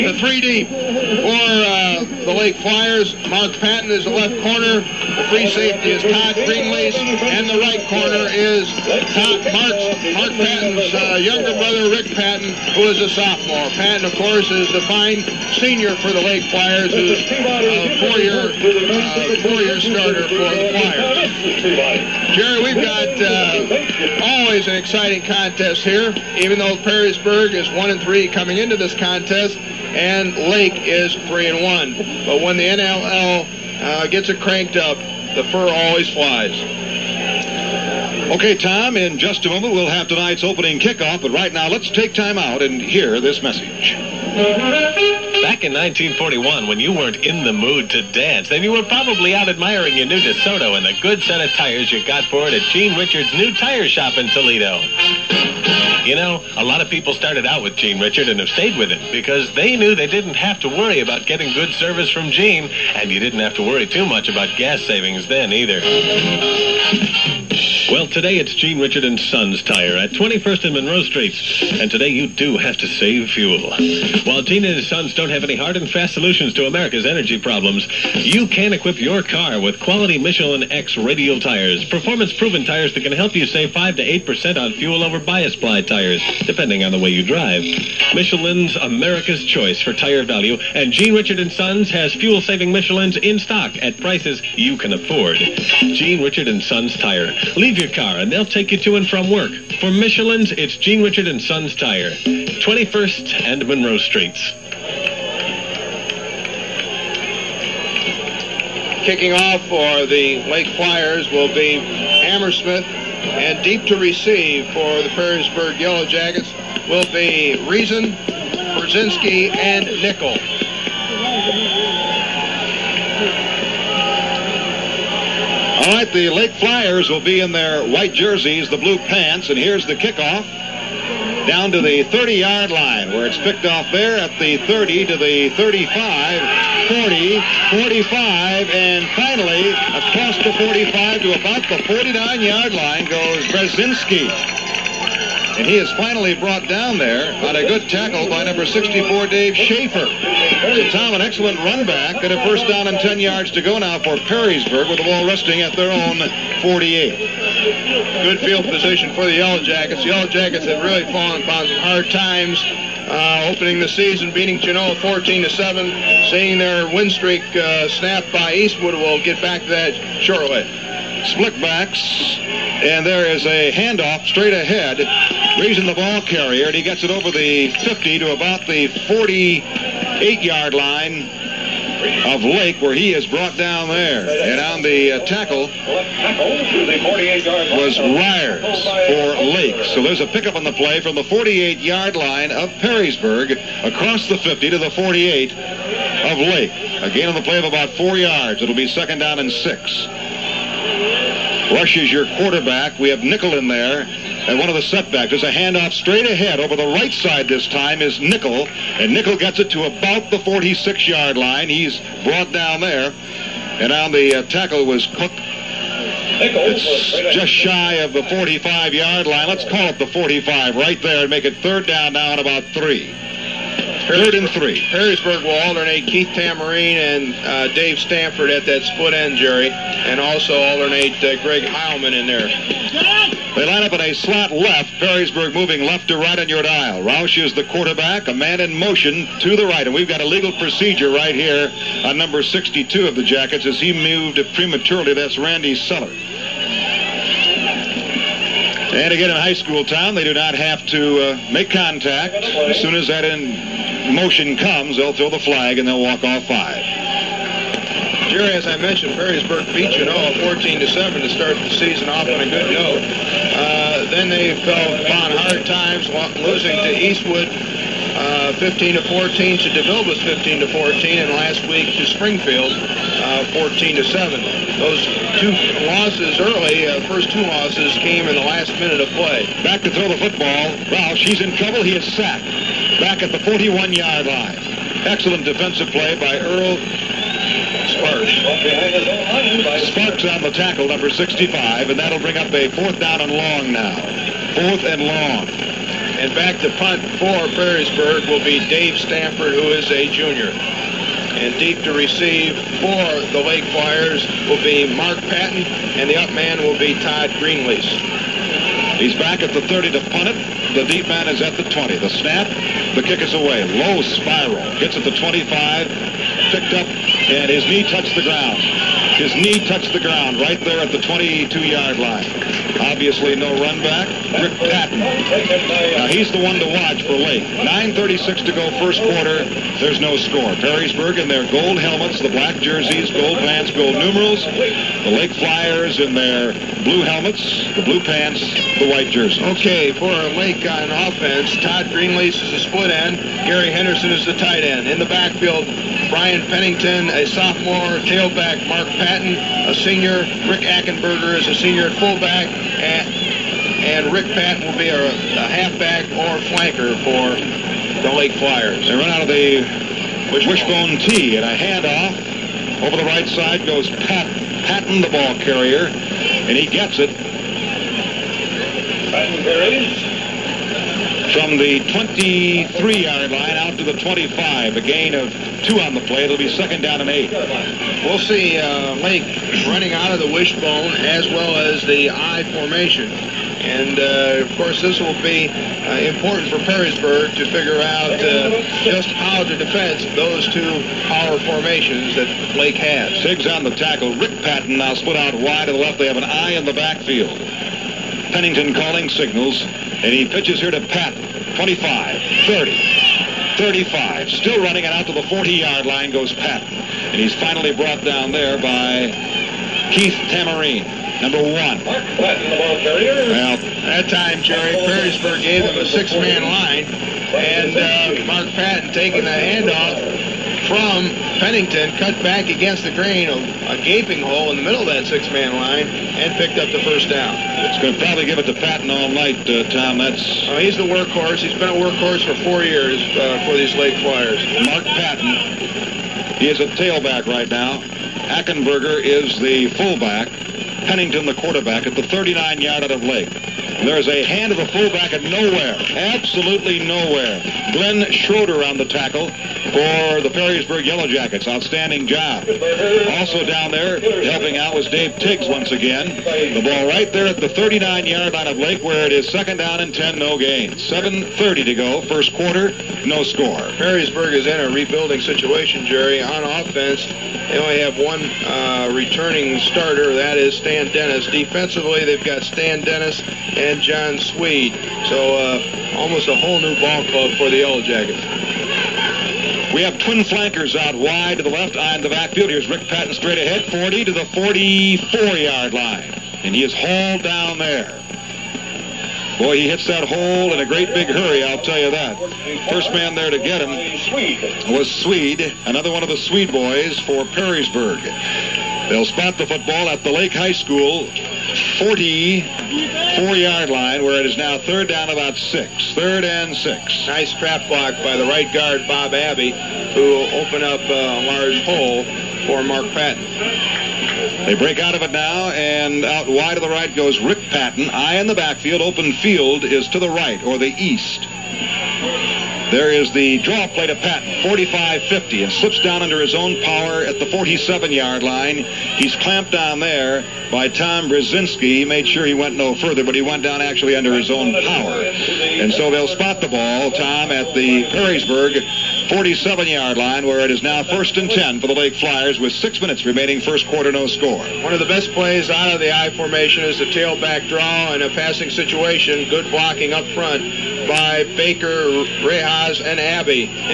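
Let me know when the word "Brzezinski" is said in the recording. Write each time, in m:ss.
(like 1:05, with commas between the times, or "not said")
1:58, 2:23, 8:51.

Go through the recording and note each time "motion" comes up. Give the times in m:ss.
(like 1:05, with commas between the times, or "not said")
3:58, 4:14.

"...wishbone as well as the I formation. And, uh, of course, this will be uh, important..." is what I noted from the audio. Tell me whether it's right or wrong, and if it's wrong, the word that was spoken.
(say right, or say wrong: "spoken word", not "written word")
right.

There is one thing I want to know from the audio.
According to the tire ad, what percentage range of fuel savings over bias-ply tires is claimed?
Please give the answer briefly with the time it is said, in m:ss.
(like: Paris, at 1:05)
5 to 8%, at 1:23.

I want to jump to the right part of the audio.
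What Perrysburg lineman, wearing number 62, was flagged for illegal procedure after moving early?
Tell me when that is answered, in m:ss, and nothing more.
4:05.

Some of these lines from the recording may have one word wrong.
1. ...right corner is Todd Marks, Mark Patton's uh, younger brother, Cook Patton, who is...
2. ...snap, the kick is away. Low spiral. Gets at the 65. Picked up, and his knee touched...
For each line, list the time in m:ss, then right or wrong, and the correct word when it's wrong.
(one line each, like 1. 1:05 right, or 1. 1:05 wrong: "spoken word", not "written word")
1. 0:07 wrong: "Rick", not "Cook"
2. 5:12 wrong: "25", not "65".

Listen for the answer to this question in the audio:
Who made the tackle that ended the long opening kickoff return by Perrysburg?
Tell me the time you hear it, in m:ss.
2:29.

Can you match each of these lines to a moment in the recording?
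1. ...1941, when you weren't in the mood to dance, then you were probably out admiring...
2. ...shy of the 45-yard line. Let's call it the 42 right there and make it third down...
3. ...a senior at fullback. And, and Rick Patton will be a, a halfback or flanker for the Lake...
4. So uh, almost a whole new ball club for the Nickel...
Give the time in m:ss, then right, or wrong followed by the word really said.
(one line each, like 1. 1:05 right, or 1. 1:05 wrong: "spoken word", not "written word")
1. 0:45 right
2. 3:37 wrong: "45", not "42"
3. 5:51 right
4. 7:55 wrong: "Yellow", not "Nickel".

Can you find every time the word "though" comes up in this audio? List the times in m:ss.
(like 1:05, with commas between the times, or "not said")
0:26.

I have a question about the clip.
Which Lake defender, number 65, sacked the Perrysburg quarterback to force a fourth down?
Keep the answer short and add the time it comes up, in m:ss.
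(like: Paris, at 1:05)
Earl Sparks, at 4:46.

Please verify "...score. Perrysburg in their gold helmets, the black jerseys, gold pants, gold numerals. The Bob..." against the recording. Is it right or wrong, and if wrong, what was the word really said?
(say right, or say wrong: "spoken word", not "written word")
wrong: "Lake", not "Bob".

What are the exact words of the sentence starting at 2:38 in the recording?
Good field position for the Yellow Jackets.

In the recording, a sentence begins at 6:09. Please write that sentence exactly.
Patton carries from the 23-yard line out to the 25, a gain of two on the play.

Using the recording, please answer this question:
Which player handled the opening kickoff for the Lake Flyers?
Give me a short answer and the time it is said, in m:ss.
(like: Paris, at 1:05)
Hammersmith, at 1:52.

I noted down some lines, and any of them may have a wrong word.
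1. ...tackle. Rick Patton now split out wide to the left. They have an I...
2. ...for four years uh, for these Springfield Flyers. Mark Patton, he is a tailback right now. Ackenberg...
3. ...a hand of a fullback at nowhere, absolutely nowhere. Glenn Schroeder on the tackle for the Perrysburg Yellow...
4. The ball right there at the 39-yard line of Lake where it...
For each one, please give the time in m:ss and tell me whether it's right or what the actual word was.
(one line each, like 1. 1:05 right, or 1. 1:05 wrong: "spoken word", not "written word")
1. 6:33 right
2. 7:12 wrong: "Lake", not "Springfield"
3. 7:24 right
4. 7:36 right.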